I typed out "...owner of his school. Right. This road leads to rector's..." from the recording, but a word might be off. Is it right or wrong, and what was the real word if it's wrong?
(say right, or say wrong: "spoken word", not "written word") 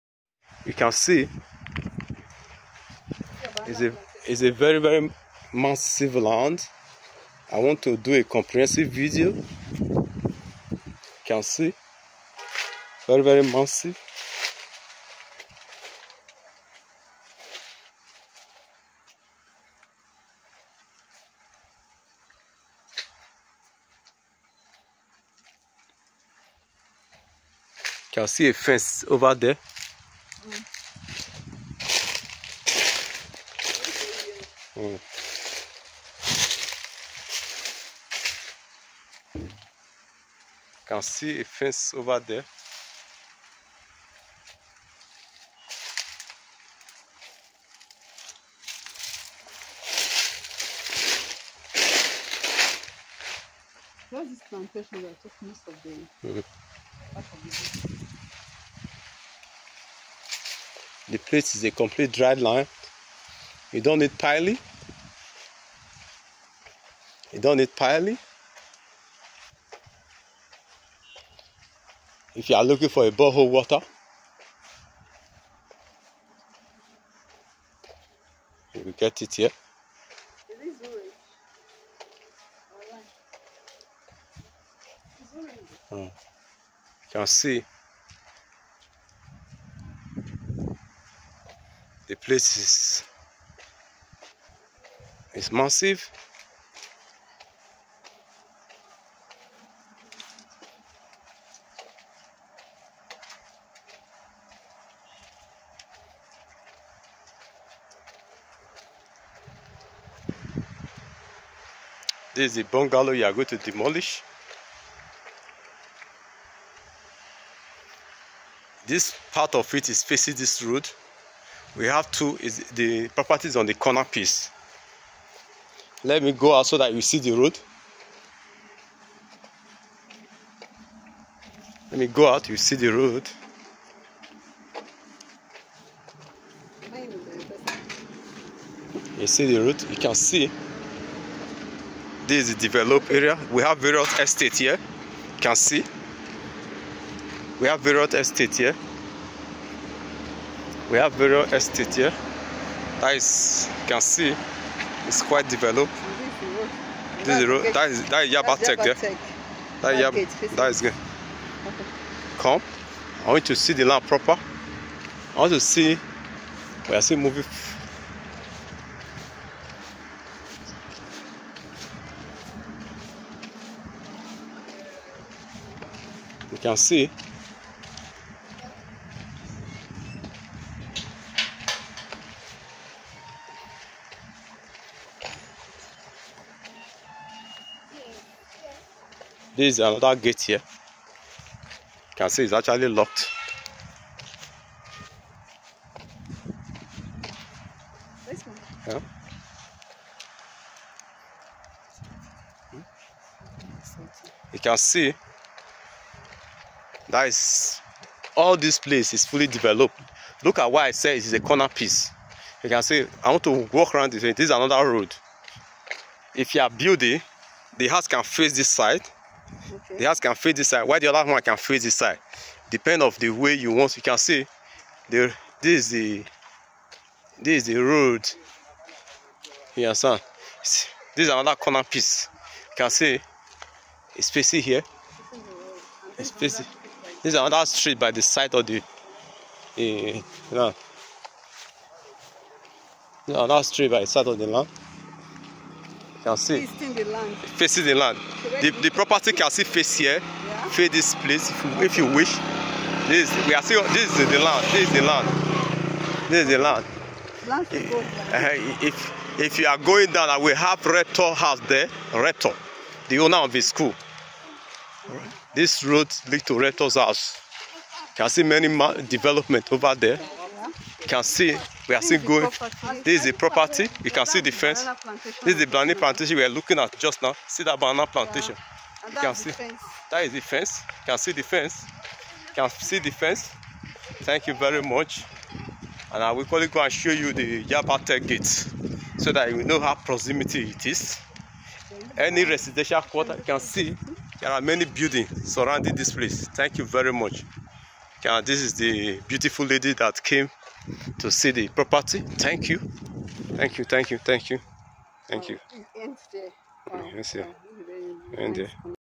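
right.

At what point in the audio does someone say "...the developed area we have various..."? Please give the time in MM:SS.
02:22.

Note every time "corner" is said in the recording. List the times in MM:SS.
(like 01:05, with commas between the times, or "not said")
02:03, 03:31, 03:51.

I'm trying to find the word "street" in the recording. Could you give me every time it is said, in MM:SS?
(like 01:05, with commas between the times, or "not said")
03:57, 04:03.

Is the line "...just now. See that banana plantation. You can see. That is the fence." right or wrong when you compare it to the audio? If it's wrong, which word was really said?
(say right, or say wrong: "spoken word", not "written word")
right.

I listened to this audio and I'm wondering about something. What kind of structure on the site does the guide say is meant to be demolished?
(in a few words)
The bungalow.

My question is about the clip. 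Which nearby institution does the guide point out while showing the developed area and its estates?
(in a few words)
Yaba Tech.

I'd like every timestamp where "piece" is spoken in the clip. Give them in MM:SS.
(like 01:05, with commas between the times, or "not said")
02:04, 03:31, 03:51.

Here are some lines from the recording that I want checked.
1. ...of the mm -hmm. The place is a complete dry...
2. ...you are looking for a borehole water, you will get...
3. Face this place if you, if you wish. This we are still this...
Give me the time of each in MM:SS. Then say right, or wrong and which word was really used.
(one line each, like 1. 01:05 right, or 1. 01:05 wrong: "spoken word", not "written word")
1. 00:55 right
2. 01:12 right
3. 04:10 right.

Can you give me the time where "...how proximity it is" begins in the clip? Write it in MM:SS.
04:49.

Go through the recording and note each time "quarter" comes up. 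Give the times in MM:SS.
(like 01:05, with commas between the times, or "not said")
04:53.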